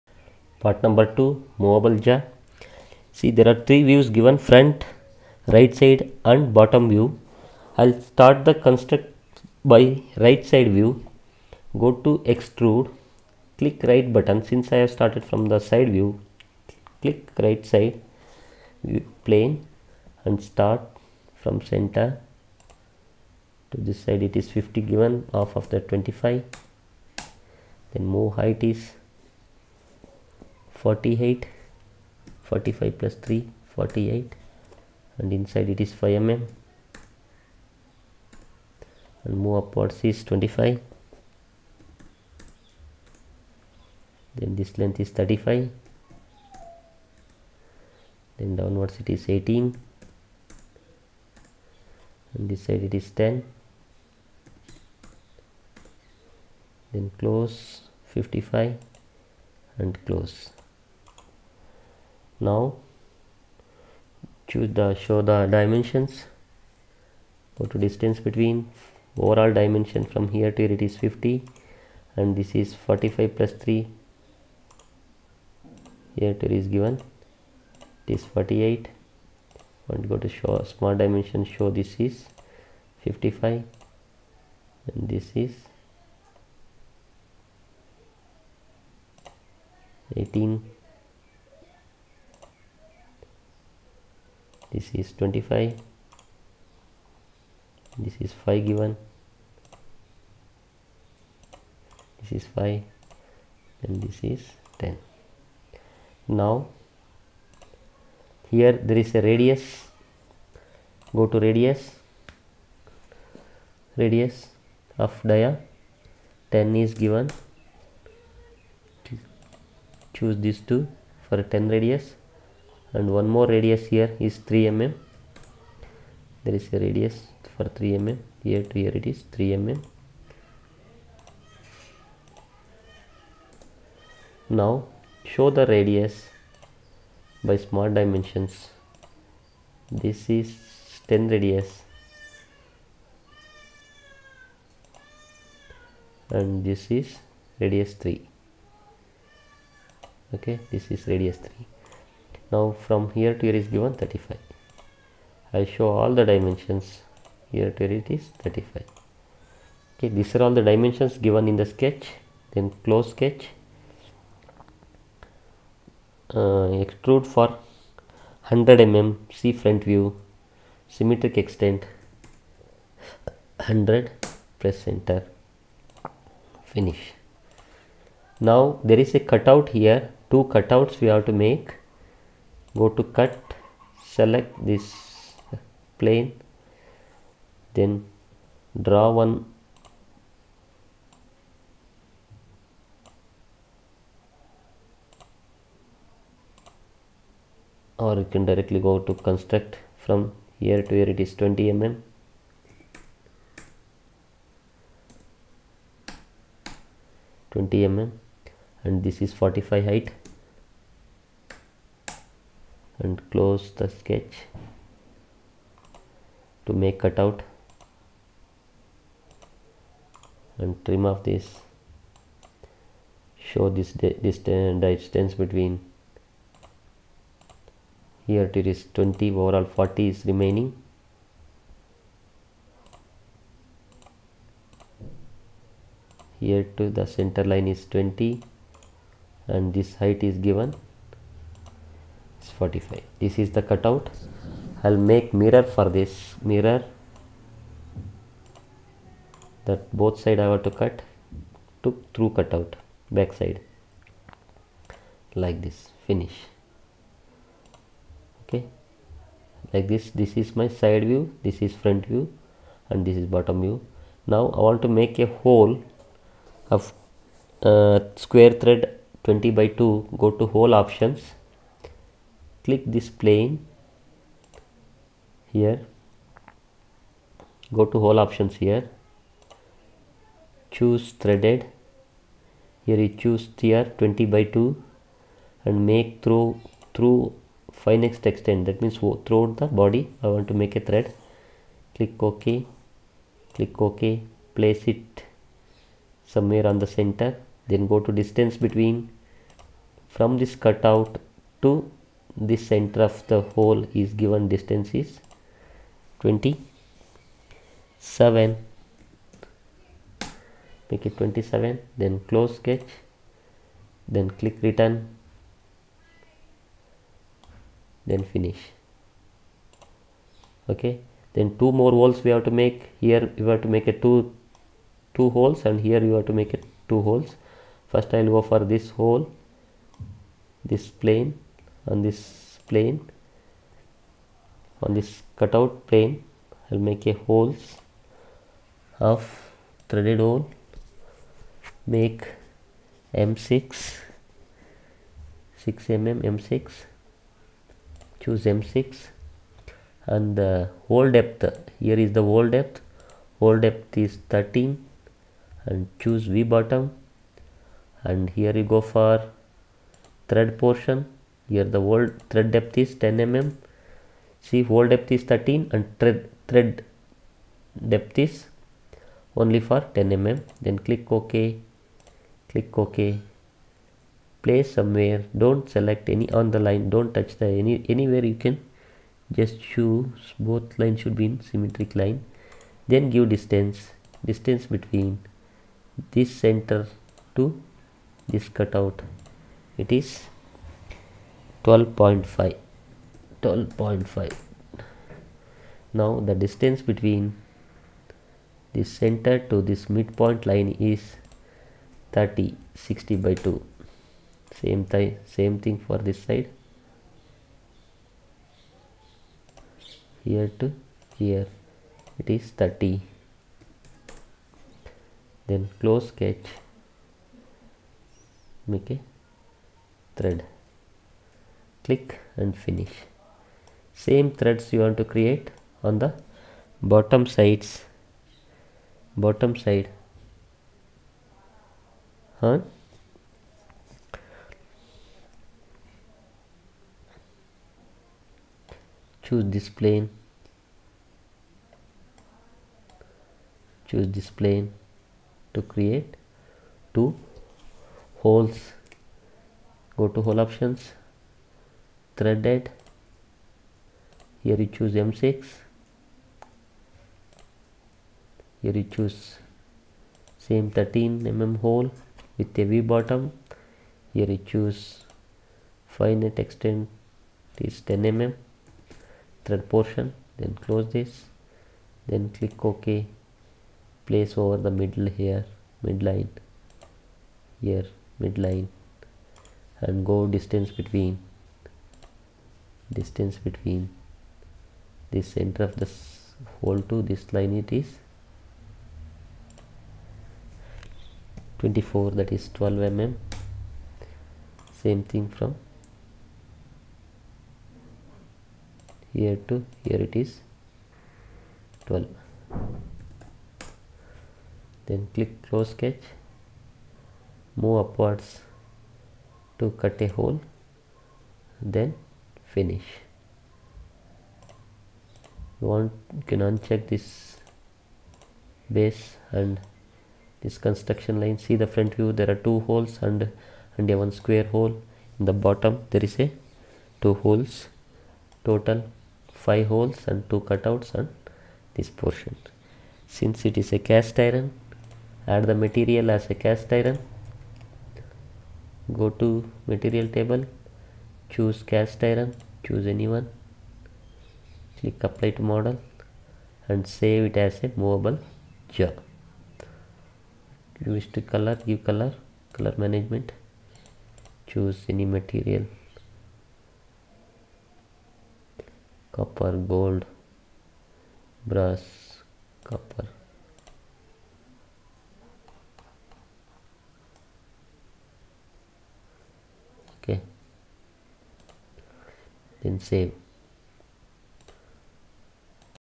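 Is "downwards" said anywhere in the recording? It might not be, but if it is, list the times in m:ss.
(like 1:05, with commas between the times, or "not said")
0:48.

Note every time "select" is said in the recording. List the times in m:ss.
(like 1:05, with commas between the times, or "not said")
3:04, 6:15.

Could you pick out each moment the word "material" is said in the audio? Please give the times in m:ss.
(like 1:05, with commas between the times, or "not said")
8:55, 8:59, 9:15.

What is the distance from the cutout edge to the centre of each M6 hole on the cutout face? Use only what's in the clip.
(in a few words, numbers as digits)
12.5.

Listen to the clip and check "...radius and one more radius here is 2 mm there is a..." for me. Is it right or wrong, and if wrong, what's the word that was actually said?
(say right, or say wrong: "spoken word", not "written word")
wrong: "3", not "2".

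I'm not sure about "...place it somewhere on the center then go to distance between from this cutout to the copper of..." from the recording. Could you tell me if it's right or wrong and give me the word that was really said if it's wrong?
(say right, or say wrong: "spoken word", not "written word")
wrong: "center", not "copper".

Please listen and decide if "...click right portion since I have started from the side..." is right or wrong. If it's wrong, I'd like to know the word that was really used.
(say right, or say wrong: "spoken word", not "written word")
wrong: "button", not "portion".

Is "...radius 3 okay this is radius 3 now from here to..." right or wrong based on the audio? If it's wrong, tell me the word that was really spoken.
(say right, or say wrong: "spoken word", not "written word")
right.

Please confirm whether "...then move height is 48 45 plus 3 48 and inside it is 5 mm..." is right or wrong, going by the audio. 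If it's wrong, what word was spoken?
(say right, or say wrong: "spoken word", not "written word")
right.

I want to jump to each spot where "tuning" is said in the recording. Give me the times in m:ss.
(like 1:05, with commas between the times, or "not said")
not said.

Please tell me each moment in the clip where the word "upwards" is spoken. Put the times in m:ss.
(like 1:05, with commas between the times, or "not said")
0:39, 8:27.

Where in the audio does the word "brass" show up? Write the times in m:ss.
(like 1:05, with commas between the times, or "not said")
9:21.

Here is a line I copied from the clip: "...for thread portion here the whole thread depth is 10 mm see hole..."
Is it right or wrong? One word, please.
right.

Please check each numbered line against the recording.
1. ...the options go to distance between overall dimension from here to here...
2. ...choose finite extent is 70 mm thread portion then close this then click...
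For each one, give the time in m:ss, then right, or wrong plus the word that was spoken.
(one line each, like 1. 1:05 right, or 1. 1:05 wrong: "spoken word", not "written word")
1. 1:05 wrong: "dimensions", not "options"
2. 7:44 wrong: "10", not "70".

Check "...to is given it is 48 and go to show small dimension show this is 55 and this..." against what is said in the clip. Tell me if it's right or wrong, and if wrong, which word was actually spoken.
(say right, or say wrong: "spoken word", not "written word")
right.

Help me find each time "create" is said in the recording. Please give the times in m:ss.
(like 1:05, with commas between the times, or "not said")
7:05, 7:25.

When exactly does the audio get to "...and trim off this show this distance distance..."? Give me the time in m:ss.
3:40.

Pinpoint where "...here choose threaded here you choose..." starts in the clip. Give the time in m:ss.
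4:38.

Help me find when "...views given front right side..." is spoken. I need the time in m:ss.
0:03.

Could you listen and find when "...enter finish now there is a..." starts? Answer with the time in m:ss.
2:54.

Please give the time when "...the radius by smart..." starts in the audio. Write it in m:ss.
2:15.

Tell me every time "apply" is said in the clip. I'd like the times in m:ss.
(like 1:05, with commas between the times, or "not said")
9:05.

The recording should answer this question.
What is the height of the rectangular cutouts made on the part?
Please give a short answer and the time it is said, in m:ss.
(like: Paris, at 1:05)
45, at 3:29.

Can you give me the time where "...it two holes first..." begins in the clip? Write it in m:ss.
5:26.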